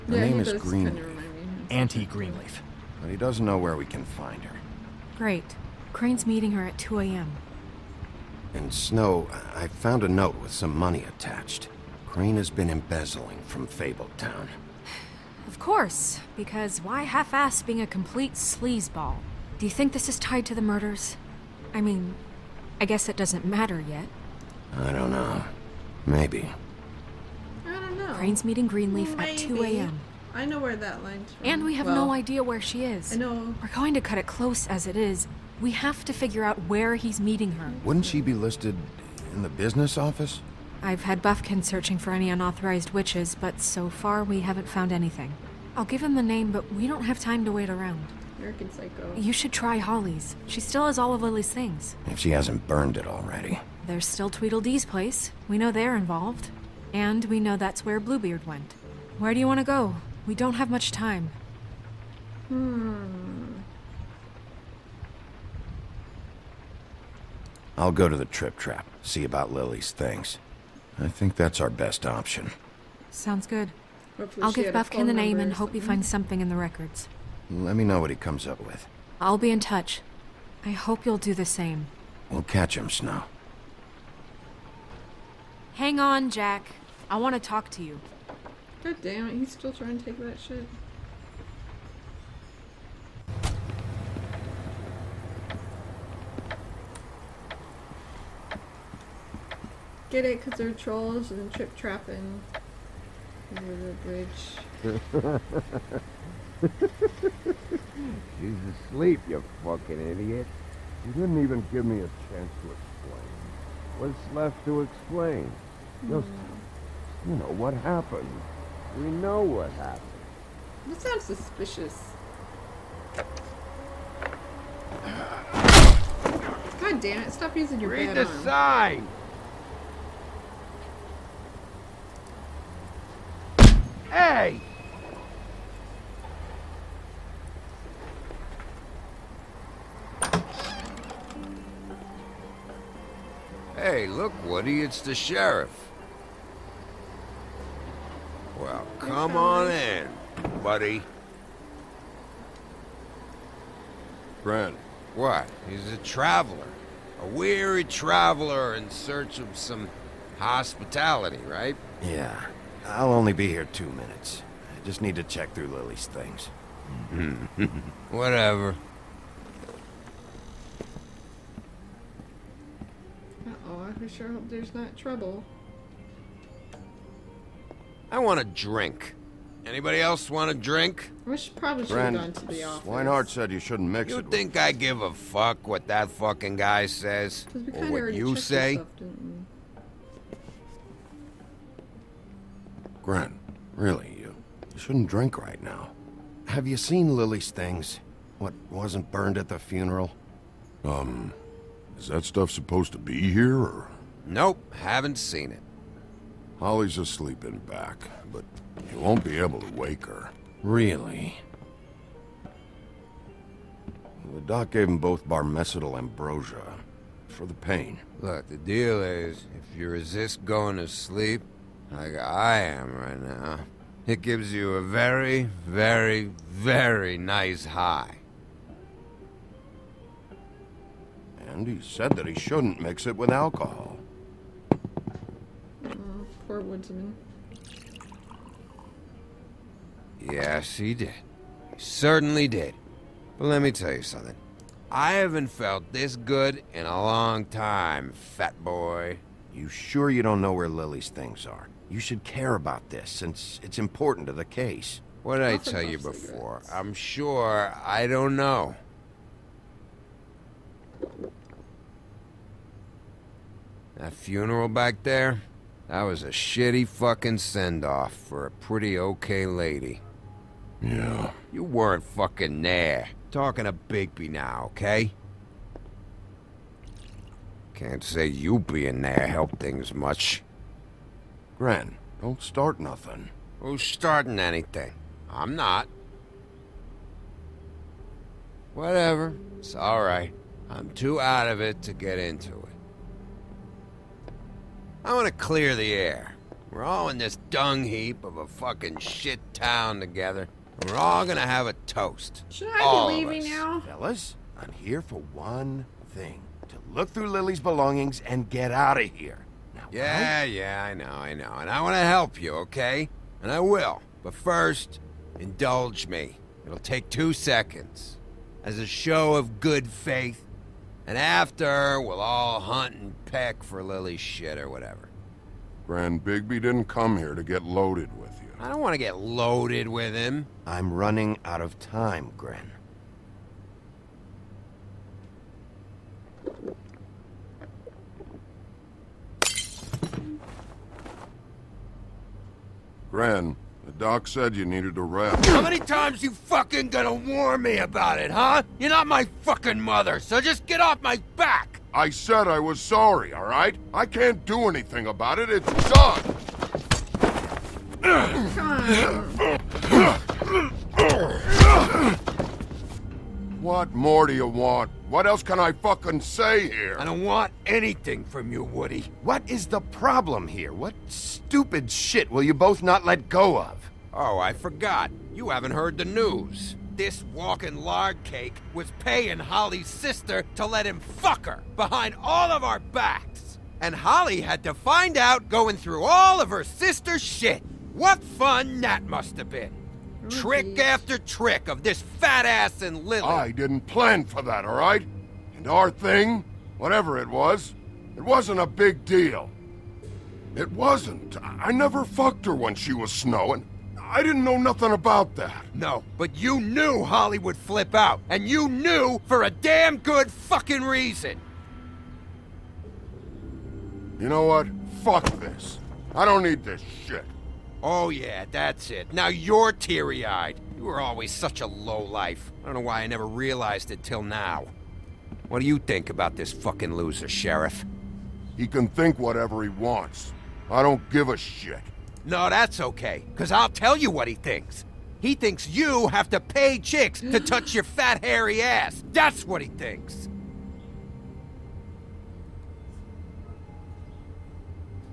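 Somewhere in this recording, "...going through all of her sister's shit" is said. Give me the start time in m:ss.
6:25.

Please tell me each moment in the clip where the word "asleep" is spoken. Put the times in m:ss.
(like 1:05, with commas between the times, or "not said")
1:48, 3:26.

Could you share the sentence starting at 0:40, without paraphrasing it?
I've had Buffkin searching for any unauthorized witches, but so far we haven't found anything.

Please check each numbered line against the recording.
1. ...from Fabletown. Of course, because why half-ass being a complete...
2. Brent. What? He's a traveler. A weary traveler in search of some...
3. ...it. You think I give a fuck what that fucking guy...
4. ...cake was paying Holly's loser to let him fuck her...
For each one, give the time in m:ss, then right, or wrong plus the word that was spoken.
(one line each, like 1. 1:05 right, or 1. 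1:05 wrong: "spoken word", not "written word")
1. 0:13 right
2. 2:34 right
3. 3:04 right
4. 6:18 wrong: "sister", not "loser".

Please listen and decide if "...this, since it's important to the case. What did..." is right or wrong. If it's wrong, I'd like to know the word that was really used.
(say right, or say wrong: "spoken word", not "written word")
right.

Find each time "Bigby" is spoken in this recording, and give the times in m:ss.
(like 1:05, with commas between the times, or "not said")
4:33, 5:26.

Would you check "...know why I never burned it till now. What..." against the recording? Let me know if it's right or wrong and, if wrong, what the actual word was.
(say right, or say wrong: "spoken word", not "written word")
wrong: "realized", not "burned".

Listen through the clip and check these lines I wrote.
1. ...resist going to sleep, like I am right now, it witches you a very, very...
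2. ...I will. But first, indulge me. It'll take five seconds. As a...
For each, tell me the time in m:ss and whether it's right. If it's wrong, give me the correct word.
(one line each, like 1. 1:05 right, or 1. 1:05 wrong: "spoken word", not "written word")
1. 3:39 wrong: "gives", not "witches"
2. 5:13 wrong: "two", not "five".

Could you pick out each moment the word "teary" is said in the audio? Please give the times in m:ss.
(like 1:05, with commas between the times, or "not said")
6:59.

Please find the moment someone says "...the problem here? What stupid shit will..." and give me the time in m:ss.
6:09.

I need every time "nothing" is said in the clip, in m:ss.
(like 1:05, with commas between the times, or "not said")
4:42, 6:44.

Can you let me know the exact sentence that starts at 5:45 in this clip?
How many times you fucking gonna warn me about it, huh?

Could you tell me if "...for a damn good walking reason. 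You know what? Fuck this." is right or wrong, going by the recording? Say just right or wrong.
wrong.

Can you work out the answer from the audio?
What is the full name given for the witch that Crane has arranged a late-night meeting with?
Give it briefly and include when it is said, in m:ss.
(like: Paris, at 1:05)
Auntie Greenleaf, at 0:01.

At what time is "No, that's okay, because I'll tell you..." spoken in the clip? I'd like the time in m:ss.
7:12.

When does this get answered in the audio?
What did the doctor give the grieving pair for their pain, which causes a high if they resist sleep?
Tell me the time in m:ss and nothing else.
3:35.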